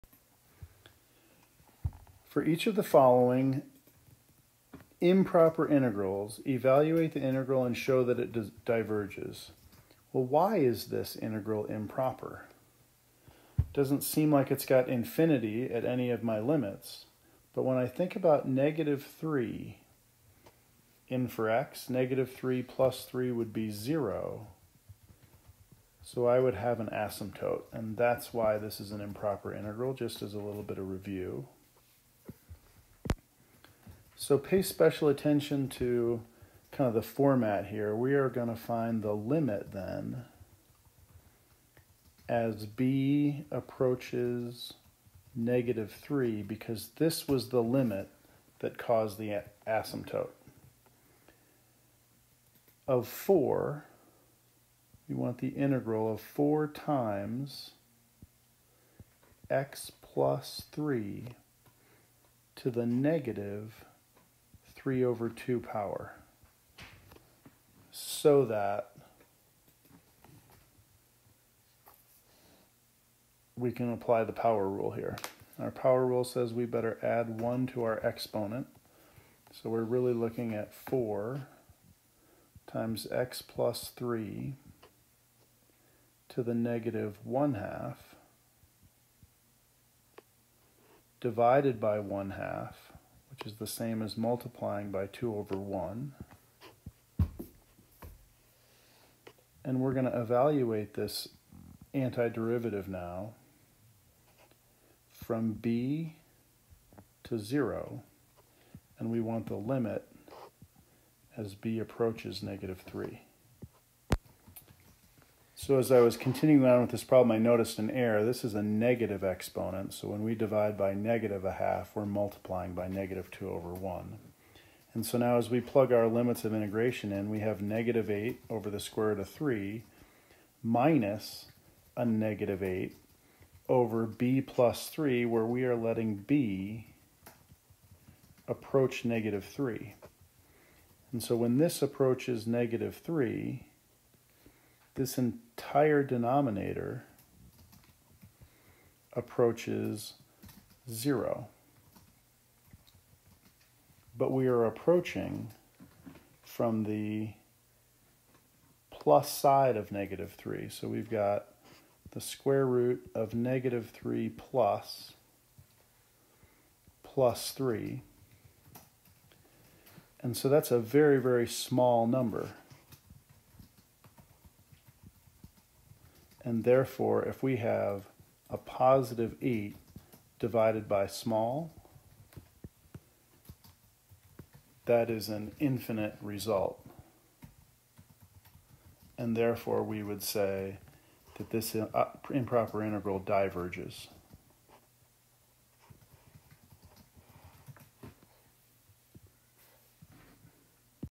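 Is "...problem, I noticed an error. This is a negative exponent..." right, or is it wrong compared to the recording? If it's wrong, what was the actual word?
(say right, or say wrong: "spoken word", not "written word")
right.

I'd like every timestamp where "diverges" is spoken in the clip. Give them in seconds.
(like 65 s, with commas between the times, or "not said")
8 s, 193 s.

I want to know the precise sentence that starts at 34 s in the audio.
So pay special attention to kind of the format here.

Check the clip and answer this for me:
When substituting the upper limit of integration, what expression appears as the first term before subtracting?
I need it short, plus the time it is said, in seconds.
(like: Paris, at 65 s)
-8 over the square root of 3, at 127 s.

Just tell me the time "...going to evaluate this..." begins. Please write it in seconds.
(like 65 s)
99 s.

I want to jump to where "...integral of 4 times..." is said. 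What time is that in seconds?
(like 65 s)
55 s.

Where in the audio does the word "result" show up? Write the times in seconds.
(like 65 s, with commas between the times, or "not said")
186 s.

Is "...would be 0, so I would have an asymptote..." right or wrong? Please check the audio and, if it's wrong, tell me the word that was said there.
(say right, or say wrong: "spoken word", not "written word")
right.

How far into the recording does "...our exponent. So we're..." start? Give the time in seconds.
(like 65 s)
77 s.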